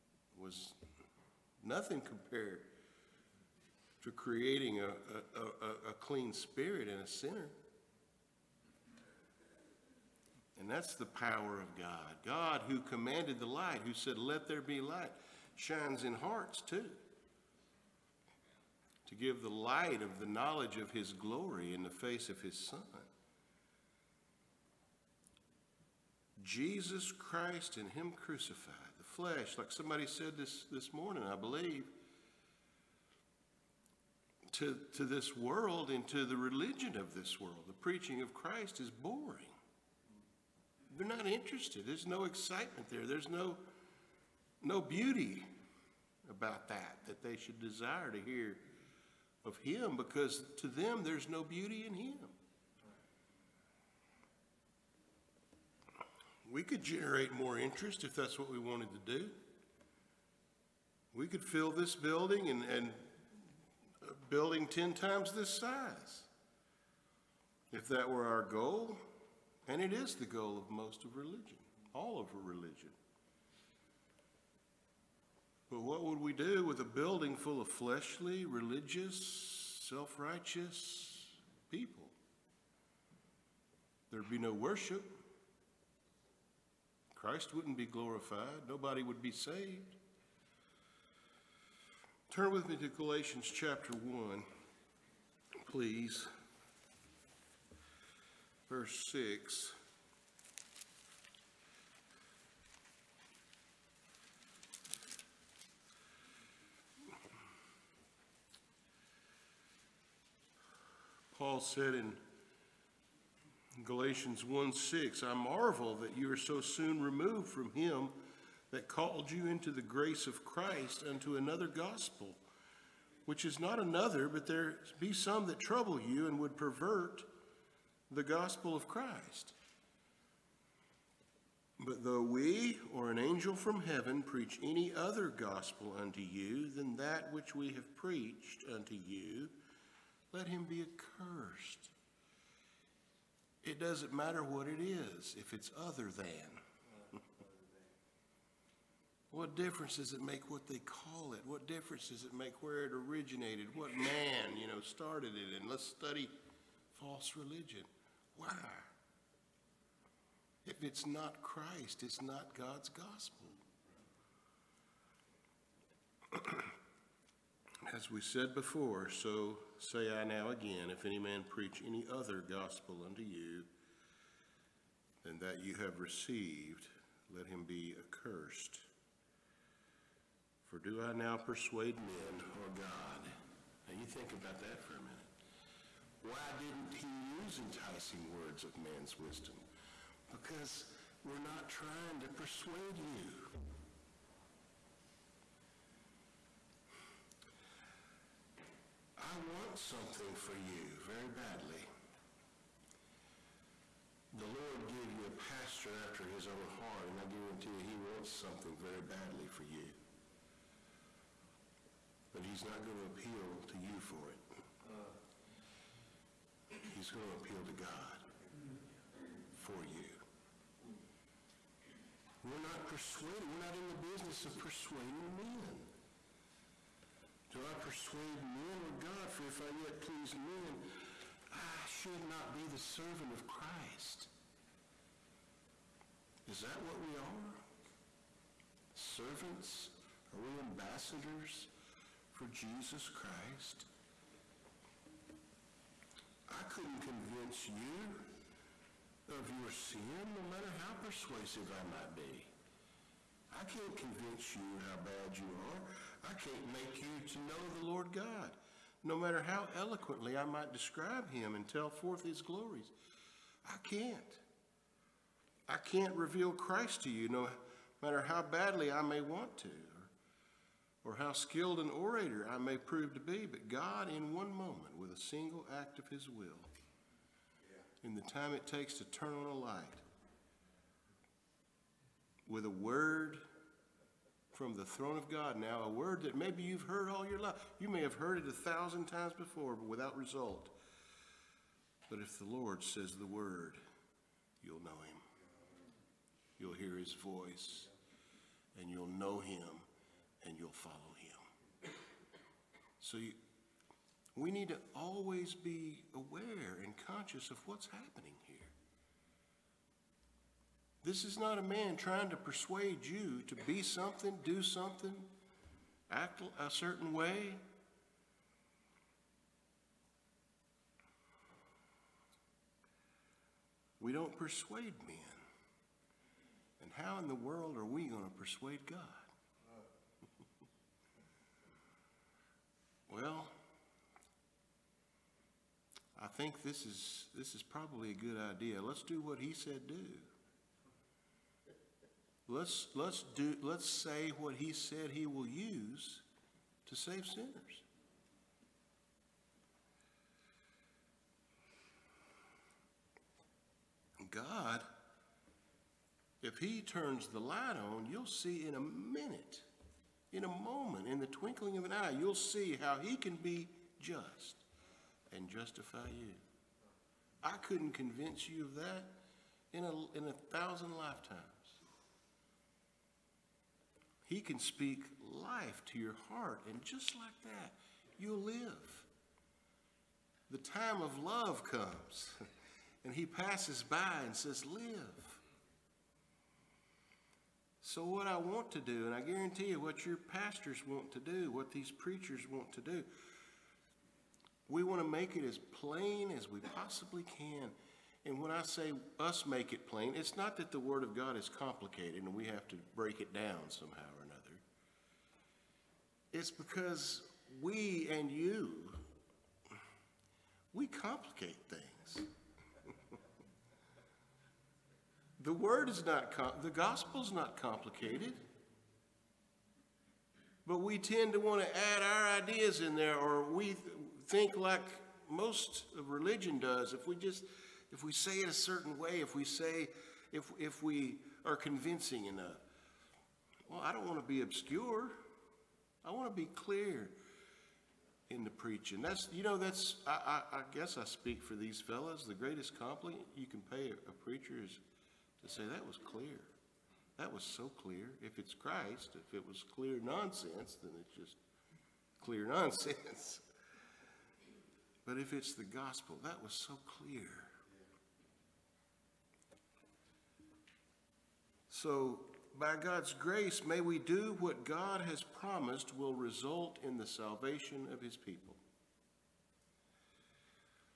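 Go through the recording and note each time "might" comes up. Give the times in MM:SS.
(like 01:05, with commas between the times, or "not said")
04:11, 04:20.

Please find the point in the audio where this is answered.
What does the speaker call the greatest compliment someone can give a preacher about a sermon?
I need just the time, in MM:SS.
07:25.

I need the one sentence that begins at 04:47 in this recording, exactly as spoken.
You may have heard it a thousand times before, but without result.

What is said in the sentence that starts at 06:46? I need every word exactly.
It's because we and you, we complicate things.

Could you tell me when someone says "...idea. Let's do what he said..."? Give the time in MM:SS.
05:38.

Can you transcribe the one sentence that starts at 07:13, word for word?
Well, I don't want to be obscure.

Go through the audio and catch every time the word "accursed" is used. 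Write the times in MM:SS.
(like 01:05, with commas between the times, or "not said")
02:20, 02:57.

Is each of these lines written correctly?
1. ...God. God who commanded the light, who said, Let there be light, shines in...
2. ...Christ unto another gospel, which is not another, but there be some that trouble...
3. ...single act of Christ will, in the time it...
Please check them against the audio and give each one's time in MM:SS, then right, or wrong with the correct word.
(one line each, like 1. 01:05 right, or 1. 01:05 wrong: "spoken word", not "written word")
1. 00:11 right
2. 02:00 right
3. 04:35 wrong: "His", not "Christ".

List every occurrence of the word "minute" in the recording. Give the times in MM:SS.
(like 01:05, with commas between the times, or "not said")
03:04, 05:58.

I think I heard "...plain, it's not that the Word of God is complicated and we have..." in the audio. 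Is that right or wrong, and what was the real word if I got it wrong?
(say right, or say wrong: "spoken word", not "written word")
right.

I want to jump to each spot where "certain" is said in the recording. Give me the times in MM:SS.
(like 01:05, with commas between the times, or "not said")
05:16, 07:08.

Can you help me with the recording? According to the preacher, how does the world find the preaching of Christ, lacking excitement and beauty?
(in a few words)
Boring.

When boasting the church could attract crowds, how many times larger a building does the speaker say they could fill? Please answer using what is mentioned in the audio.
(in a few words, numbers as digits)
10 times.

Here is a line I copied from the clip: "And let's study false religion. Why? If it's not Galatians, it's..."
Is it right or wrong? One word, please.
wrong.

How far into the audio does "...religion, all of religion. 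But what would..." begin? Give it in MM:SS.
01:11.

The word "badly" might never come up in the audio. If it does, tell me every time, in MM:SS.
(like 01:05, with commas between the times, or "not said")
03:21, 03:29, 04:28.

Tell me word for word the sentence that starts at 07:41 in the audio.
So, by God's grace, may we do what God has promised will result in the salvation of his people.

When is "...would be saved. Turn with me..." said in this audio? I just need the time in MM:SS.
01:29.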